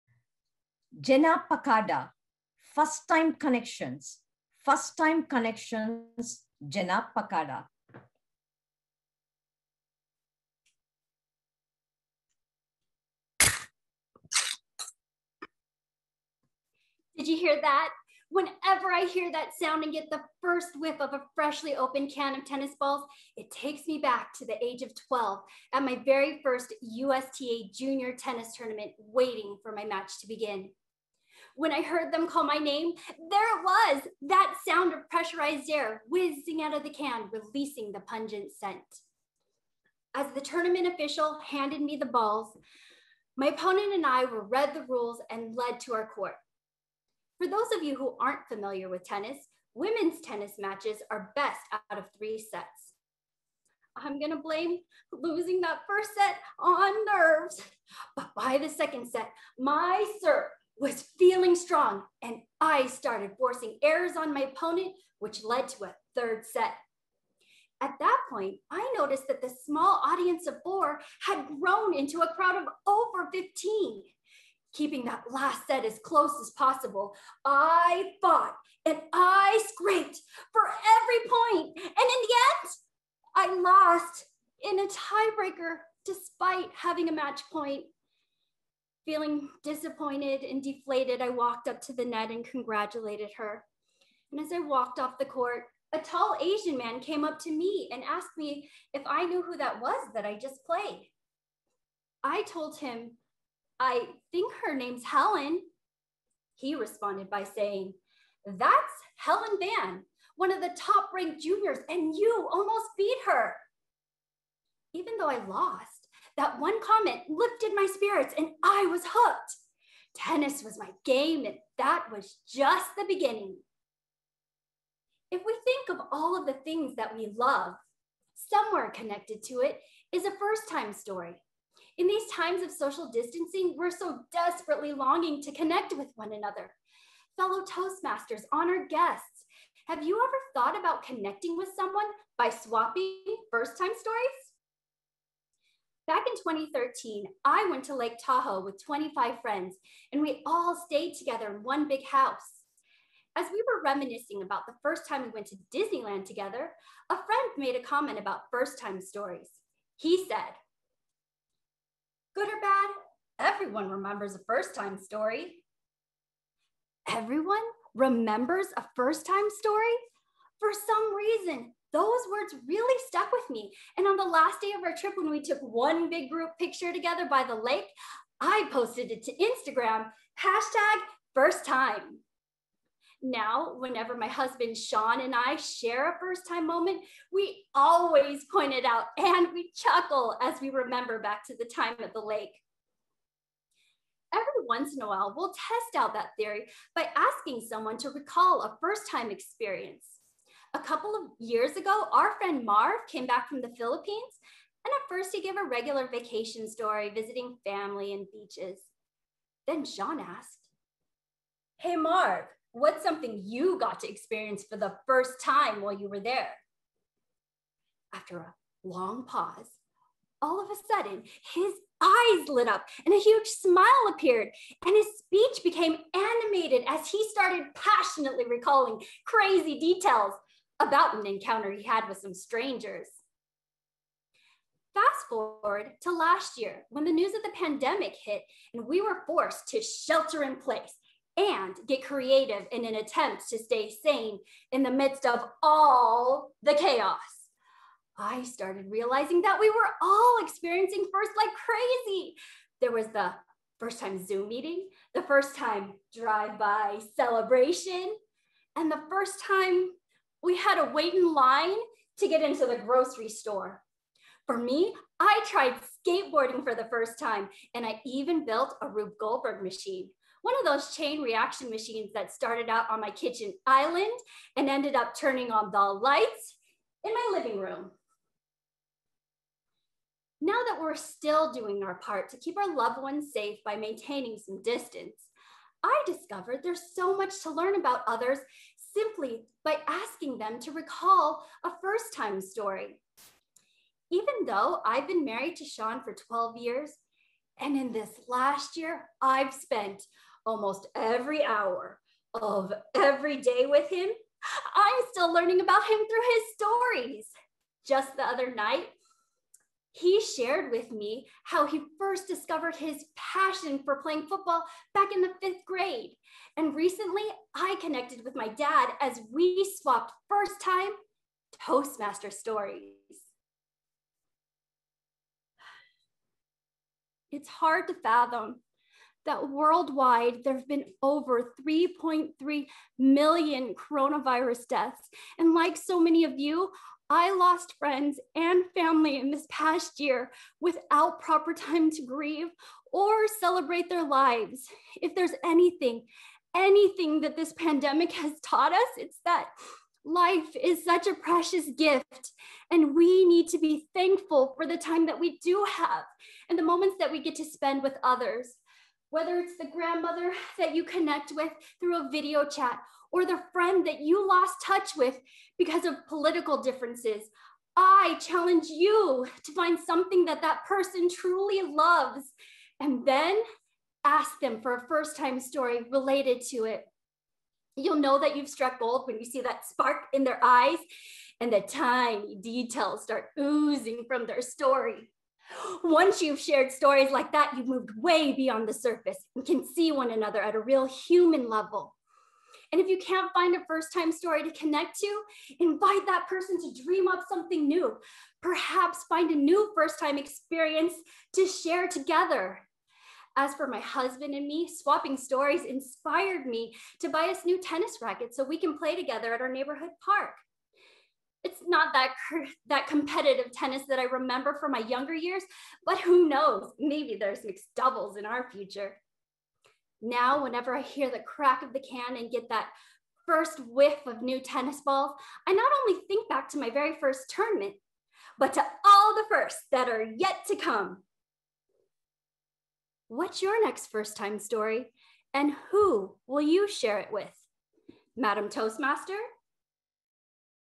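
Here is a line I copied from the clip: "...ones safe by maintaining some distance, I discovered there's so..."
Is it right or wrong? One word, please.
right.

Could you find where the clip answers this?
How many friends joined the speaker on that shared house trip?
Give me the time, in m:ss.
2:28.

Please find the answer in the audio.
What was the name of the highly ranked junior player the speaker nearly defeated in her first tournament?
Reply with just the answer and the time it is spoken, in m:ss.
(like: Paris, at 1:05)
Helen Van, at 1:49.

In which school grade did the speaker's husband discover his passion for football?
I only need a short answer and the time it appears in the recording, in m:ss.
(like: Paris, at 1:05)
fifth grade, at 5:15.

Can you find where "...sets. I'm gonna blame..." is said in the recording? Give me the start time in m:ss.
0:52.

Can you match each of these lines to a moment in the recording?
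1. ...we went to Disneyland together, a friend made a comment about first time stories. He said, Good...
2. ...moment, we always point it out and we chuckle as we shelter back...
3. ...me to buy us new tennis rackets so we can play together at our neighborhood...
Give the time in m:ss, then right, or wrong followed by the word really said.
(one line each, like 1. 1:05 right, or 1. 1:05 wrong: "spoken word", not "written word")
1. 2:35 right
2. 3:06 wrong: "remember", not "shelter"
3. 6:46 right.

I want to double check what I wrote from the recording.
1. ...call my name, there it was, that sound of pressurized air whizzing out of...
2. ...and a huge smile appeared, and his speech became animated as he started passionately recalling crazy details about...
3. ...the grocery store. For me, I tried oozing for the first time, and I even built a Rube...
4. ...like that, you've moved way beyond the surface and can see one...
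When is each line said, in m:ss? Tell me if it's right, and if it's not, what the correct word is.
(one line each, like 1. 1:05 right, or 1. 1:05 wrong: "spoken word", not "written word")
1. 0:32 right
2. 3:43 right
3. 4:22 wrong: "skateboarding", not "oozing"
4. 6:27 right.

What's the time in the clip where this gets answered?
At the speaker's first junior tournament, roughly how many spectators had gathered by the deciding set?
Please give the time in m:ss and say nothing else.
1:12.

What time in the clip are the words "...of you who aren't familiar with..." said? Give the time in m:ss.
0:47.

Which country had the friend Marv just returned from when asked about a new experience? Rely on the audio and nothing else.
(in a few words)
Philippines.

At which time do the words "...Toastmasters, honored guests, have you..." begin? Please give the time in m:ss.
2:17.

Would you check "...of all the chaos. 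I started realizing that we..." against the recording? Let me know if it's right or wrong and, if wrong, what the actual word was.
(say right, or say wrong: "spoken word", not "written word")
right.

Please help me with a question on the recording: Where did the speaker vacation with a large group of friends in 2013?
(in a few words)
Lake Tahoe.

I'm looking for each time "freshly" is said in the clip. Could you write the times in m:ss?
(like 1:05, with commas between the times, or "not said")
0:21.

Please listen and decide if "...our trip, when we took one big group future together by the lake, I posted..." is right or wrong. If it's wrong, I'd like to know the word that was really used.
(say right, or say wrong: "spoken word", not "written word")
wrong: "picture", not "future".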